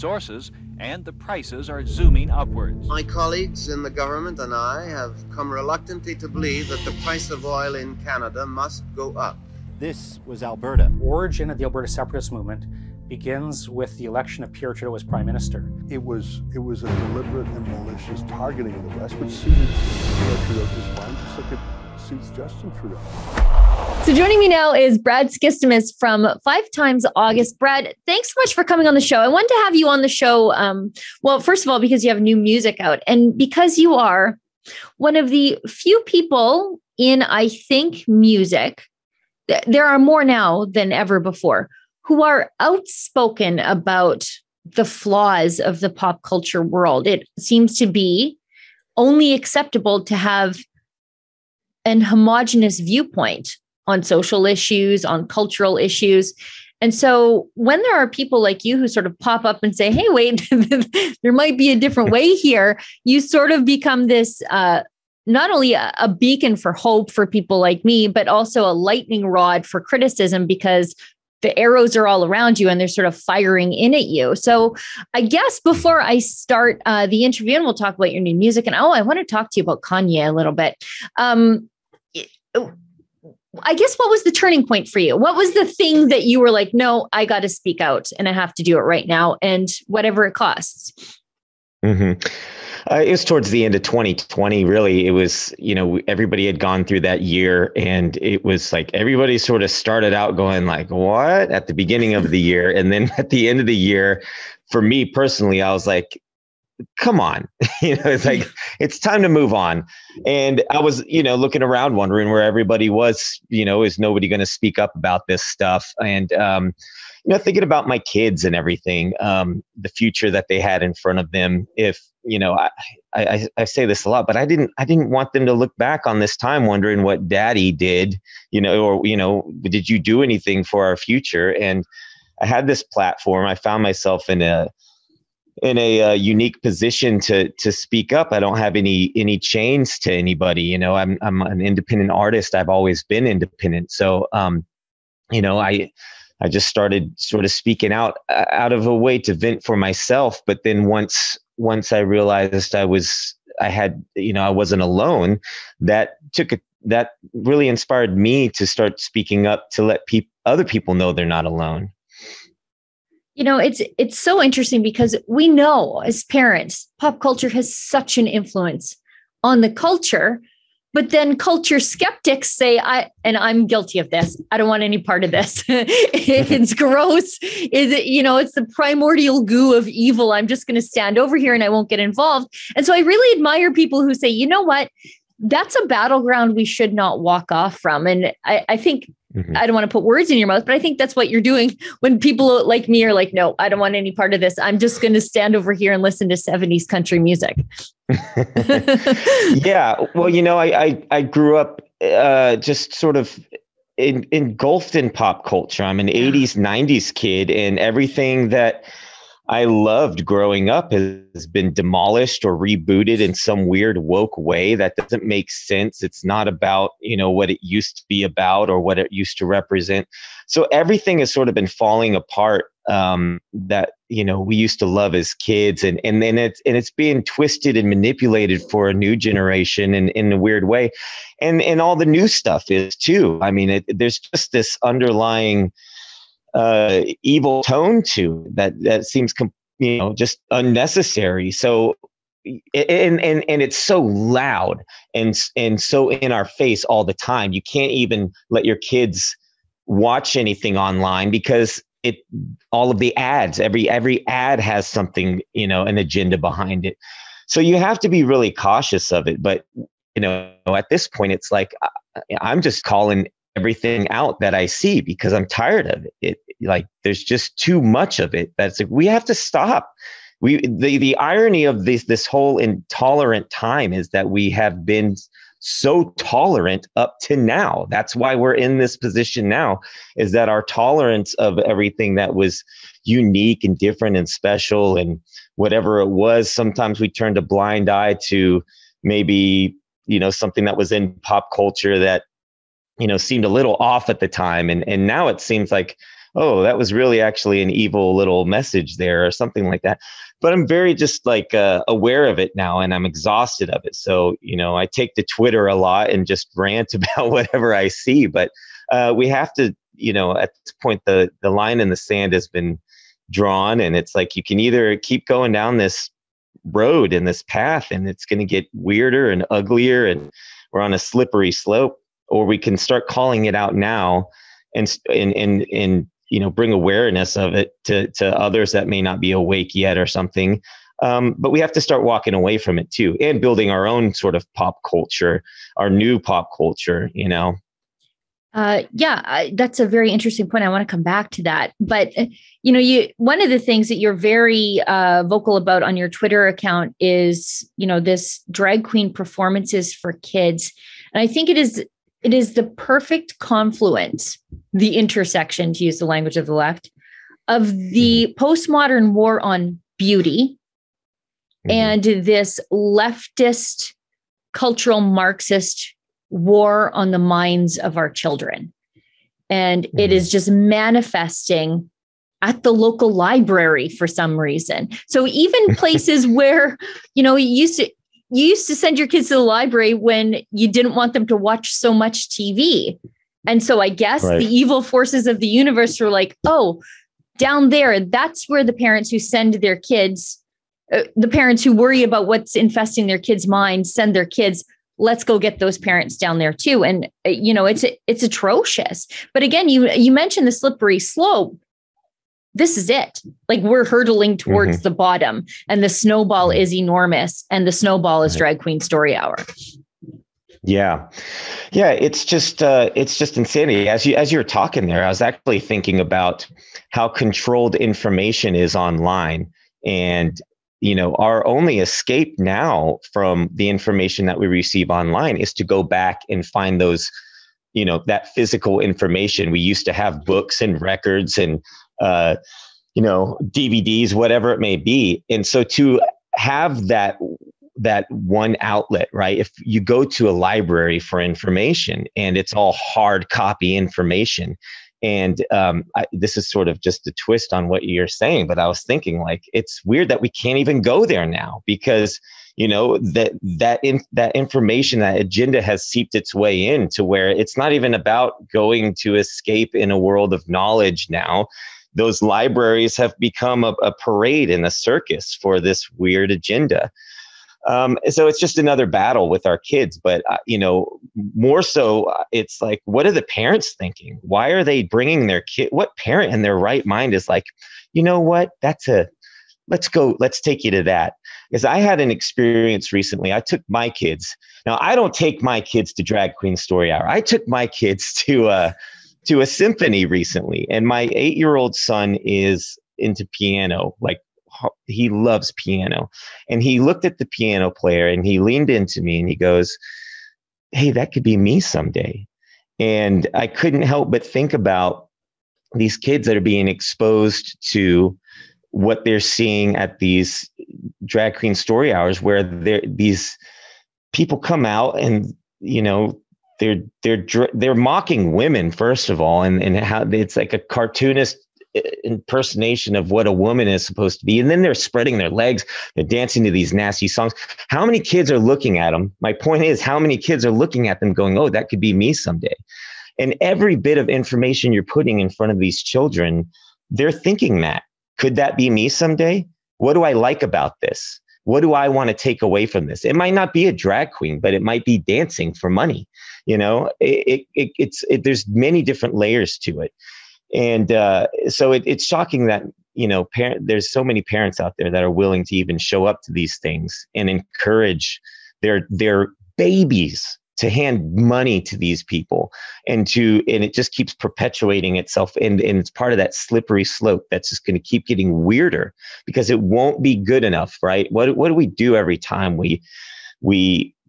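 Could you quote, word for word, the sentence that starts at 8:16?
And he looked at the piano player and he leaned into me and he goes, Hey, that could be me someday.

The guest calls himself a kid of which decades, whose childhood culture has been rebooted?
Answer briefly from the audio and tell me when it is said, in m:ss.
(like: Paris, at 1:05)
80s, 90s, at 3:26.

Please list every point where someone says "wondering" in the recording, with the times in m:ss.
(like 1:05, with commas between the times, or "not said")
1:51, 2:06.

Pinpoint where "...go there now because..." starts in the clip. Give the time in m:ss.
7:30.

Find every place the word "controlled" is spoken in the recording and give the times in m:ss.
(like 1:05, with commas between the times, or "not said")
6:57.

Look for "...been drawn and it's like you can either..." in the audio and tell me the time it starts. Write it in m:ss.
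5:12.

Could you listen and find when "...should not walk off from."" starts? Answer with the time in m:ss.
3:06.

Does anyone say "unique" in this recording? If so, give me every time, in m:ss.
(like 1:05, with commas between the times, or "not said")
2:16, 4:43.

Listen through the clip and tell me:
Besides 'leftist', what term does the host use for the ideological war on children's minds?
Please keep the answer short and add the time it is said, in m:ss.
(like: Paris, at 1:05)
cultural Marxist, at 6:04.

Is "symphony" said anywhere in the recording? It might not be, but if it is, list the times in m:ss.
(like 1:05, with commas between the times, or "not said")
8:09.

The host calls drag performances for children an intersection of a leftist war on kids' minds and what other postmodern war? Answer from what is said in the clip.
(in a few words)
war on beauty.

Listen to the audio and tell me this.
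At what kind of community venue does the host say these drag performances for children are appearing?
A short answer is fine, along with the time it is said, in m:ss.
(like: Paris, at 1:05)
local library, at 6:12.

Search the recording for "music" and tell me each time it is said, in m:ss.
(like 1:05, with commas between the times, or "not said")
0:32, 0:38, 1:18, 3:17.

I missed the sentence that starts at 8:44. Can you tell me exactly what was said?
And then they're spreading their legs, they're dancing to these nasty songs.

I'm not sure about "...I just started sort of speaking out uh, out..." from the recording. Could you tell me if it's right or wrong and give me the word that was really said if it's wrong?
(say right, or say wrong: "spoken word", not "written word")
right.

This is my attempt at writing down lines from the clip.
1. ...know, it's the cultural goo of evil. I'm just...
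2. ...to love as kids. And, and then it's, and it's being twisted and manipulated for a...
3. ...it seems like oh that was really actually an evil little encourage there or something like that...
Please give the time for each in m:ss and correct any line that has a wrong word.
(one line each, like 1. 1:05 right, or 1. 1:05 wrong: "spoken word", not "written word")
1. 2:58 wrong: "primordial", not "cultural"
2. 3:44 right
3. 4:55 wrong: "message", not "encourage".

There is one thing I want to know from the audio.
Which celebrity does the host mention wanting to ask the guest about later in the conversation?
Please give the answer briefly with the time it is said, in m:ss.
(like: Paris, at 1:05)
Kanye, at 1:19.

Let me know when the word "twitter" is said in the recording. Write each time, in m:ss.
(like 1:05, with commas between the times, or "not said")
5:05, 5:46.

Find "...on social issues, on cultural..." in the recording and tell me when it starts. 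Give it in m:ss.
0:53.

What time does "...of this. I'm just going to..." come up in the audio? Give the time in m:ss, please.
3:14.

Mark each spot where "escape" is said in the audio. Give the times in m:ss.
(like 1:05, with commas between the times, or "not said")
7:01, 7:39.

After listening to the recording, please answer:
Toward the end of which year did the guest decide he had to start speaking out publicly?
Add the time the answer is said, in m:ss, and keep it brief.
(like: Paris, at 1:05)
2020, at 1:33.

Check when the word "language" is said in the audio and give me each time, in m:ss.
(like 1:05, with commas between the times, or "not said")
5:56.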